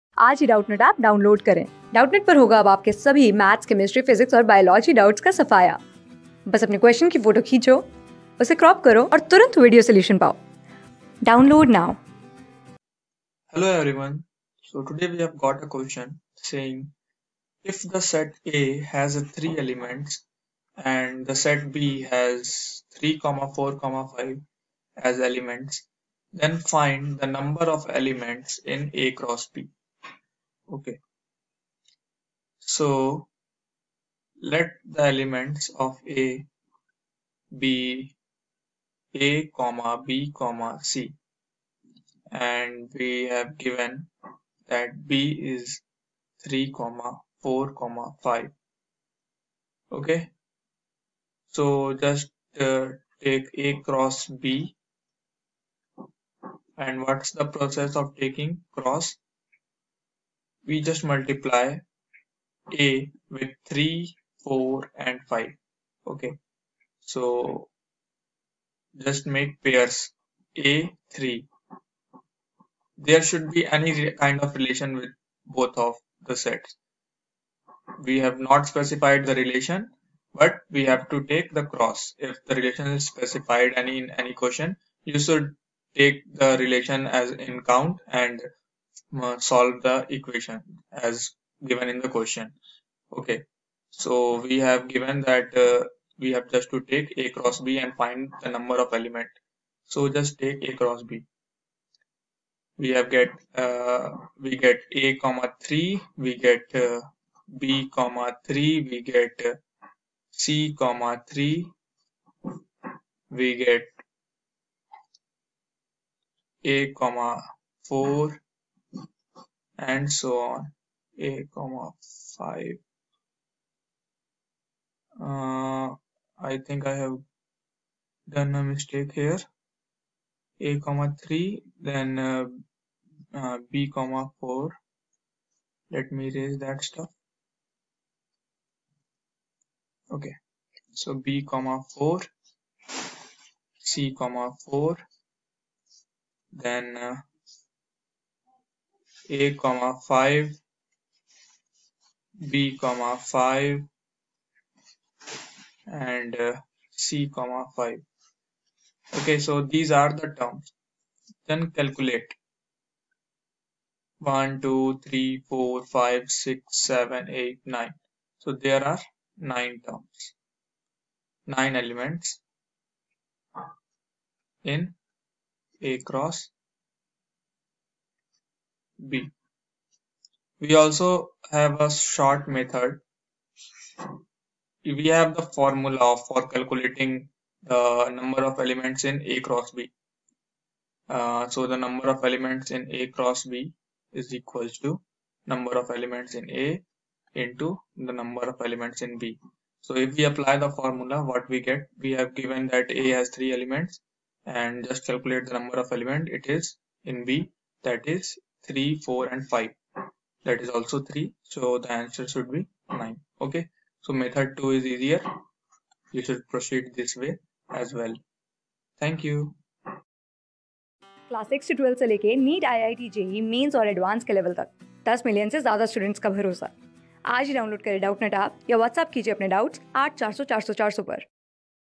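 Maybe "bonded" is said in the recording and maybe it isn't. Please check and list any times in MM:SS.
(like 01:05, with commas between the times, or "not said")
not said.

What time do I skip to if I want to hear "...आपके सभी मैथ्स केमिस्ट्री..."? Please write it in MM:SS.
00:02.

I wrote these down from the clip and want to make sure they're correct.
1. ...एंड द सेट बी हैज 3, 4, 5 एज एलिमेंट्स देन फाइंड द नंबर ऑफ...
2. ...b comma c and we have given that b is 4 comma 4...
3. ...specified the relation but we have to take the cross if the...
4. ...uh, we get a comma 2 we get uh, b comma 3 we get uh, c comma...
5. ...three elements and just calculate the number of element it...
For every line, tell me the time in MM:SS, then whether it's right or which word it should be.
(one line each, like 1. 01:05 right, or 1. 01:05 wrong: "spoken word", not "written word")
1. 00:20 right
2. 00:40 wrong: "3", not "4"
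3. 01:18 right
4. 01:43 wrong: "3", not "2"
5. 03:23 right.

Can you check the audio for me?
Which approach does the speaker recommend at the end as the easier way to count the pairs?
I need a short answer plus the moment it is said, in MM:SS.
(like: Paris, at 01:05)
Method 2, at 03:34.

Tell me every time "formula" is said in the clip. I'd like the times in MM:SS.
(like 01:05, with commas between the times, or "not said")
03:05, 03:20.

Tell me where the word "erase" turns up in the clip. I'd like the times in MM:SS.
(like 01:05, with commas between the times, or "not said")
02:16.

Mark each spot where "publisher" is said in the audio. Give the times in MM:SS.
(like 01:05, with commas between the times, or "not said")
not said.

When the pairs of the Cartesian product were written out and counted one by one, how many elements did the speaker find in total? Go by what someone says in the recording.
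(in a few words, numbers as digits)
9.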